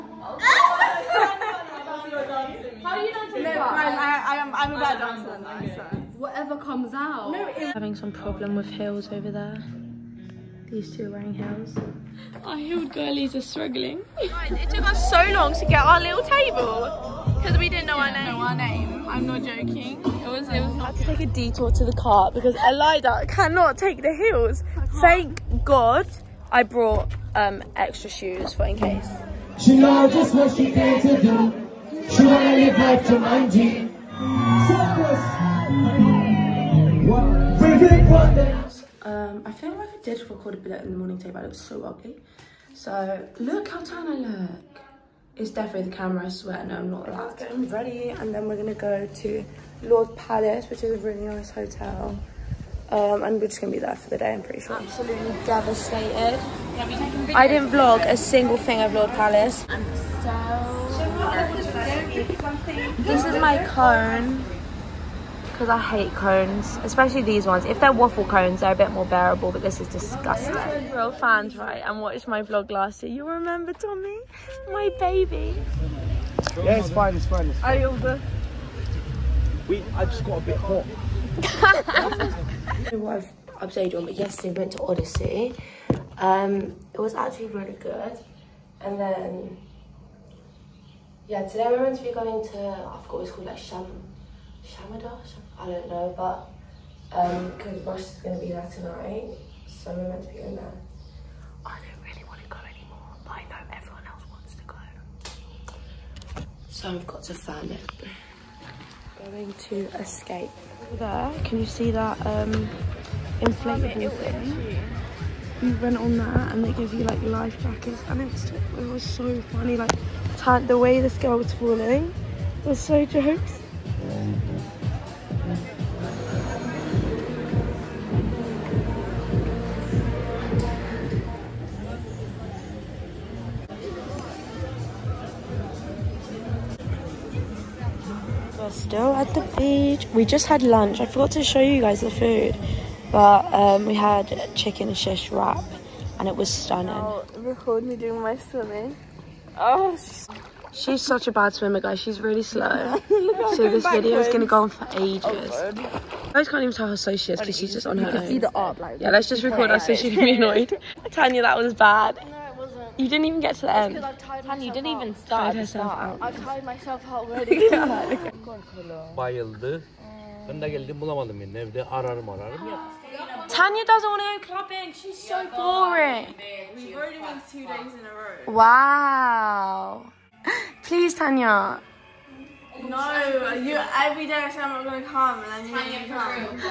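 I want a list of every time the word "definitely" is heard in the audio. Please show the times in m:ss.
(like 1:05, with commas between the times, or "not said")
0:45.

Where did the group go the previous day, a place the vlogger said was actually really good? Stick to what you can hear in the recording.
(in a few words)
Odyssey.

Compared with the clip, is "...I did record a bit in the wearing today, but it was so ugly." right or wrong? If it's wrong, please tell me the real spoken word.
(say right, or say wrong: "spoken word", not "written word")
wrong: "morning", not "wearing".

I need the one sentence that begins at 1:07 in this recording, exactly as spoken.
If they're waffle cones, they're a bit more bearable, but this is disgusting.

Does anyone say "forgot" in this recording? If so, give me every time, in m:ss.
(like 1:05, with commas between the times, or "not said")
1:33, 2:21.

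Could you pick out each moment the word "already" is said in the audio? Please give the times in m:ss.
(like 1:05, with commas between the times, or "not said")
2:47, 2:56.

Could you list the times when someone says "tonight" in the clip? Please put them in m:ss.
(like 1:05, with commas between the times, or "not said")
1:38.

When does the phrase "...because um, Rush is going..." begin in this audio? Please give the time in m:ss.
1:37.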